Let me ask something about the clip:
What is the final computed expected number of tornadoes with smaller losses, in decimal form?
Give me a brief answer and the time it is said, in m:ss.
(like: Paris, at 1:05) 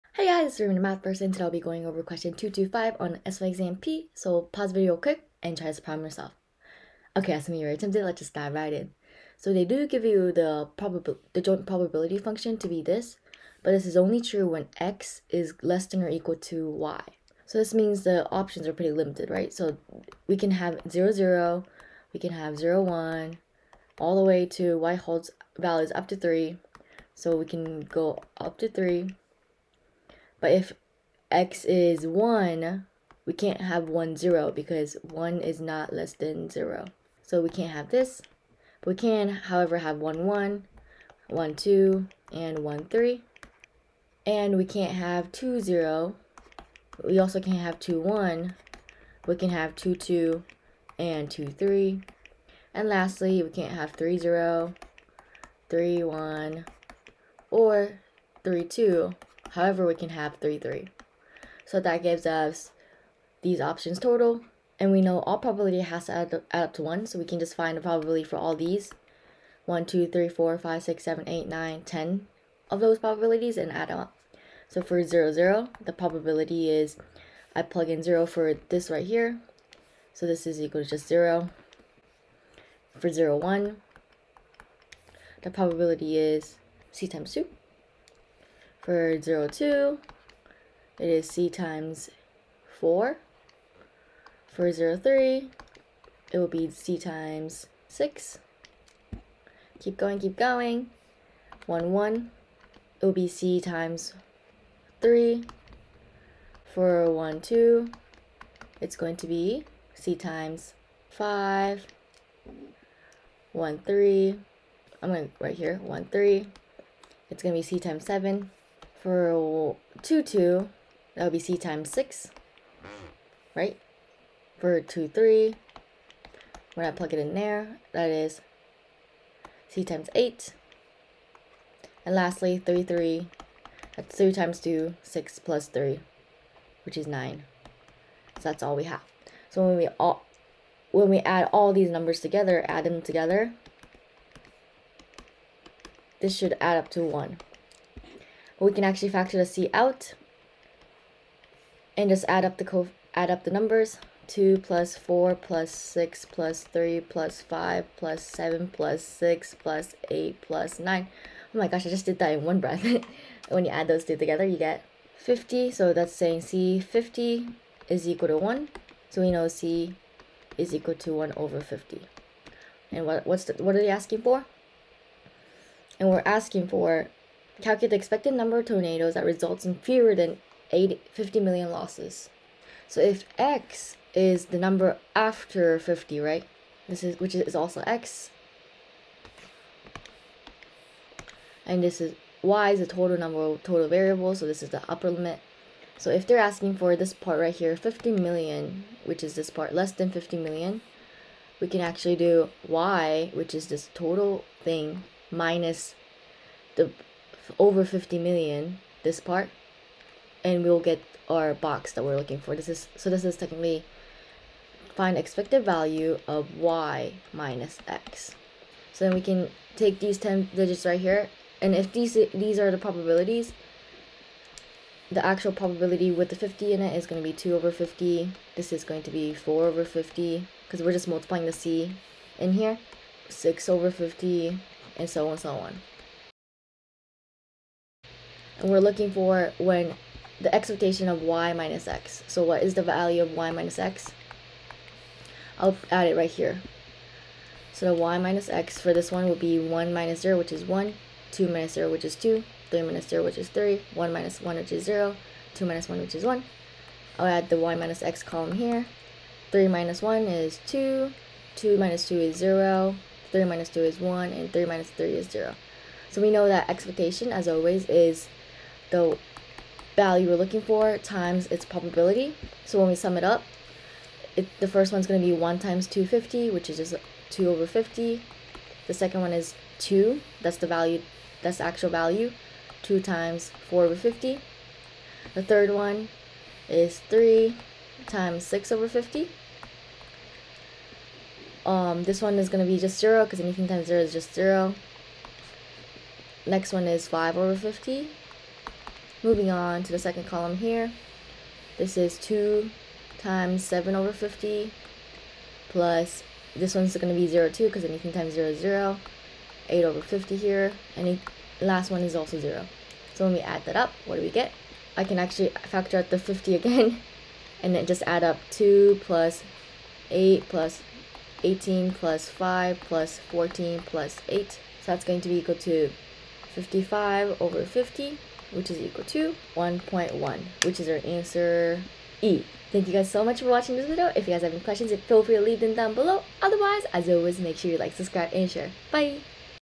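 1.1, at 5:29.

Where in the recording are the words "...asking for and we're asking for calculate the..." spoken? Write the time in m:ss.
2:53.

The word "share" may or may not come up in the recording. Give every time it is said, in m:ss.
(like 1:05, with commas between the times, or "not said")
5:38.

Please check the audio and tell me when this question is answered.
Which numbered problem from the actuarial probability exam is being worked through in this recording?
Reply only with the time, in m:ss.
0:02.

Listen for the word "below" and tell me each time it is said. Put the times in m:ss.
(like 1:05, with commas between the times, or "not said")
5:35.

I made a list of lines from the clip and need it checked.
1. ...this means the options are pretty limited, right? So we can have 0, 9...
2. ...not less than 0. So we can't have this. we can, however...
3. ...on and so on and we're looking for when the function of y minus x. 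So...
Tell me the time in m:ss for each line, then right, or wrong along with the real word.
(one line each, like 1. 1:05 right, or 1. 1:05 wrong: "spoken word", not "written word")
1. 0:17 wrong: "0", not "9"
2. 0:35 right
3. 3:55 wrong: "expectation", not "function".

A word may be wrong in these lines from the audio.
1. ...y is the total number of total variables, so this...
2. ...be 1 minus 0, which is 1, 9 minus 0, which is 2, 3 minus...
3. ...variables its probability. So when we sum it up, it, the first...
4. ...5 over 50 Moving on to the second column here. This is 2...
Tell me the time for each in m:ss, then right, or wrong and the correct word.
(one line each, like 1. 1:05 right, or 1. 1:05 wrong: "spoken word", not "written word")
1. 3:12 right
2. 4:09 wrong: "2", not "9"
3. 4:30 wrong: "times", not "variables"
4. 4:57 right.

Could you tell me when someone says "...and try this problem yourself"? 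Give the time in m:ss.
0:05.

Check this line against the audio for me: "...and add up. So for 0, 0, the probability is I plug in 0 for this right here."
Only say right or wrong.
right.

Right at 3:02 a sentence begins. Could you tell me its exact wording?
So if x is the number after 50, right?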